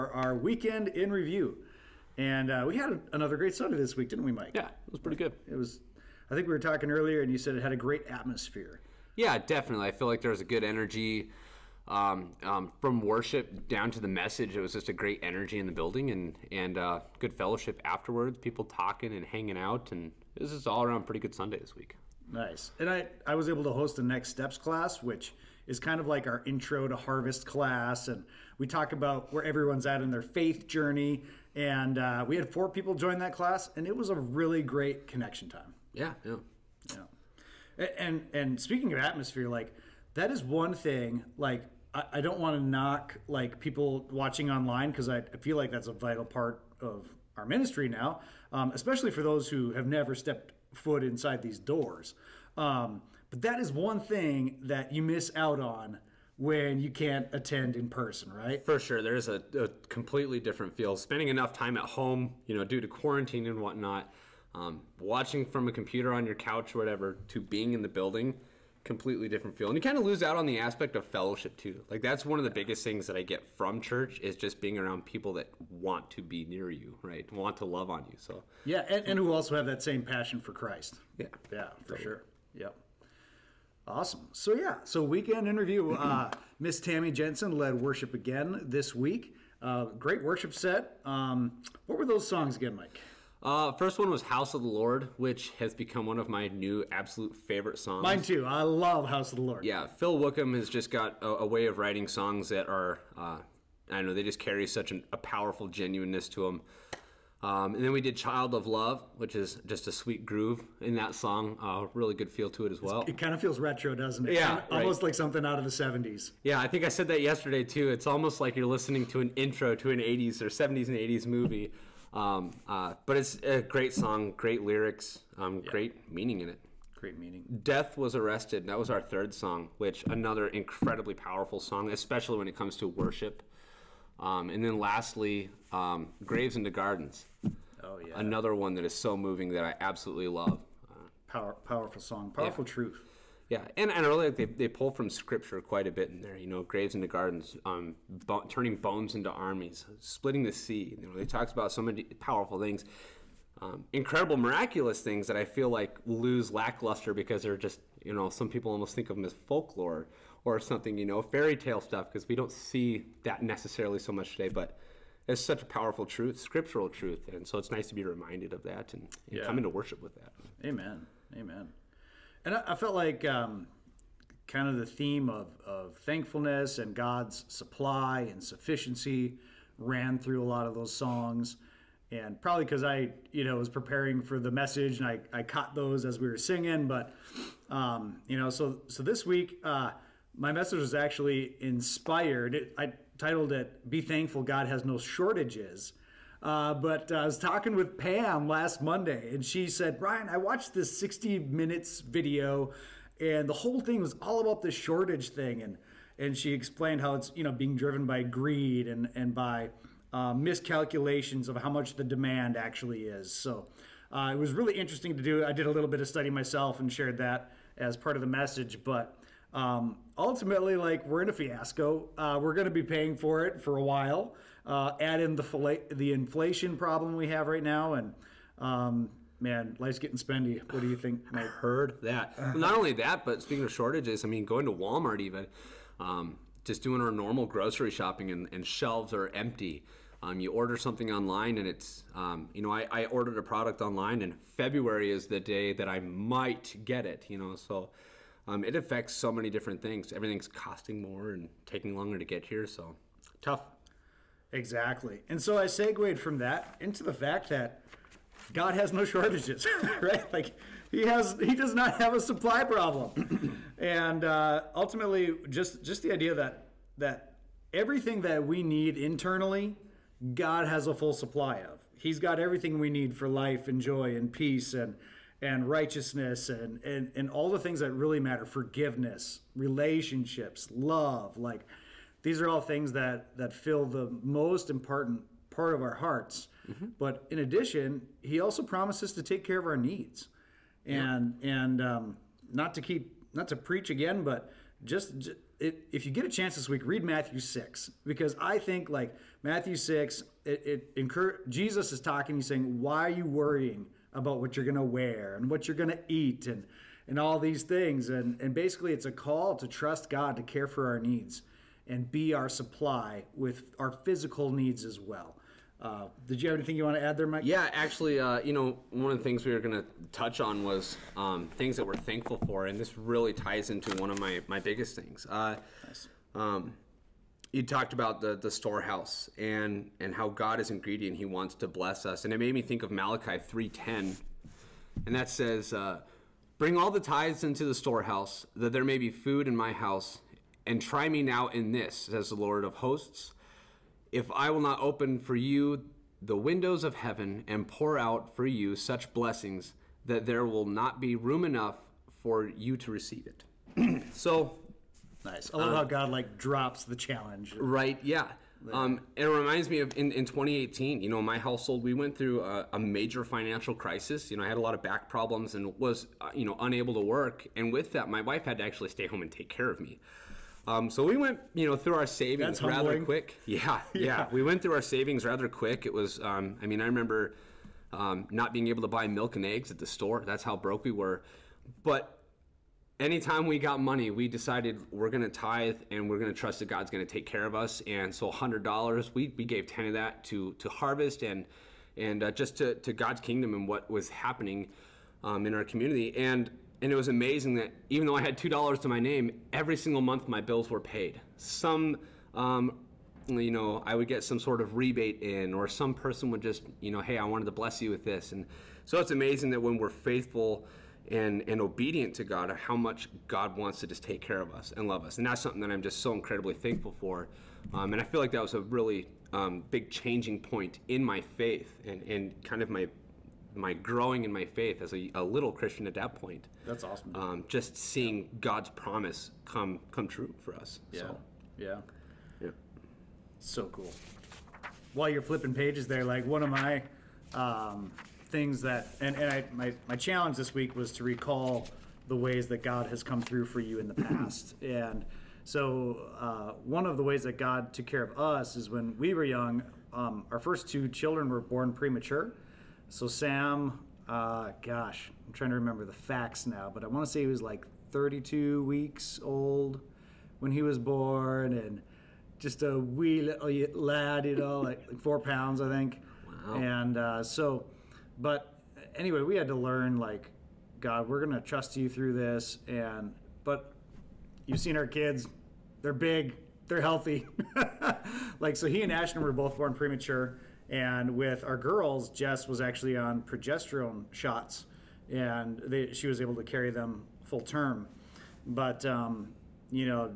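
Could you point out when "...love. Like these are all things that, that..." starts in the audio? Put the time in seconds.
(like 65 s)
280 s.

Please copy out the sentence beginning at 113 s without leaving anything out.
It's, it kind of feels retro, doesn't it?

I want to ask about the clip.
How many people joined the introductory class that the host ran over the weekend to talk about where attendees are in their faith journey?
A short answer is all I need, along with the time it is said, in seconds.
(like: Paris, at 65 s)
4, at 32 s.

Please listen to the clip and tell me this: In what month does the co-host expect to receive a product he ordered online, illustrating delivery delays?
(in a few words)
February.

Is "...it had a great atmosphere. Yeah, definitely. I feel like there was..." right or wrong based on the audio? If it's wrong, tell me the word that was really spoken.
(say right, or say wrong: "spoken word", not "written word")
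right.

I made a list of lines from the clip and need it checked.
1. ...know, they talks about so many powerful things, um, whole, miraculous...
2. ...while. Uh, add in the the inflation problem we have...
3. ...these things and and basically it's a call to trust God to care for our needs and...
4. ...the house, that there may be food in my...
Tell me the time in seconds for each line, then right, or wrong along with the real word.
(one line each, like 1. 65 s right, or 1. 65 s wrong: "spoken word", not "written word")
1. 151 s wrong: "incredible", not "whole"
2. 223 s right
3. 307 s right
4. 337 s wrong: "storehouse", not "house".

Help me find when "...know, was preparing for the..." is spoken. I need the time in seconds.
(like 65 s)
183 s.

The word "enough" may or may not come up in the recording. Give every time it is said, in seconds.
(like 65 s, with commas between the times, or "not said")
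61 s, 351 s.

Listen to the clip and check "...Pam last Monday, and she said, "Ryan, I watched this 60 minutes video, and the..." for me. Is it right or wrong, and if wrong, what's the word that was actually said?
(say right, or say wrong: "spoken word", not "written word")
right.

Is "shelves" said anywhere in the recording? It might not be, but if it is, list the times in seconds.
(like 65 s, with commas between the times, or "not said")
238 s.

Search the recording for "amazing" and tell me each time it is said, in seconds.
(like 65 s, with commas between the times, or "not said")
397 s, 409 s.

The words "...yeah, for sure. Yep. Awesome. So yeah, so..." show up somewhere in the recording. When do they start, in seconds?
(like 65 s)
81 s.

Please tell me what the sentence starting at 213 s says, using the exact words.
So uh, it was really interesting to do.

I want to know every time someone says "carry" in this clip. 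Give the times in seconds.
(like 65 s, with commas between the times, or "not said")
104 s, 486 s.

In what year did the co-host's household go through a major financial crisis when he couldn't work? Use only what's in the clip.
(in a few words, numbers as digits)
2018.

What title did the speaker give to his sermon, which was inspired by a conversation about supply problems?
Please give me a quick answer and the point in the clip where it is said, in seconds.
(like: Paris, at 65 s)
Be Thankful God Has No Shortages, at 193 s.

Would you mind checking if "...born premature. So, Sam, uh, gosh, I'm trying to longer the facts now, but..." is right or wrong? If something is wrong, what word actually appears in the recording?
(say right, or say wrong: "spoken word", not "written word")
wrong: "remember", not "longer".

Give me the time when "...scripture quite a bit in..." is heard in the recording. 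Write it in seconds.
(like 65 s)
145 s.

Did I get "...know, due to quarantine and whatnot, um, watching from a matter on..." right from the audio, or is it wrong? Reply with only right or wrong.
wrong.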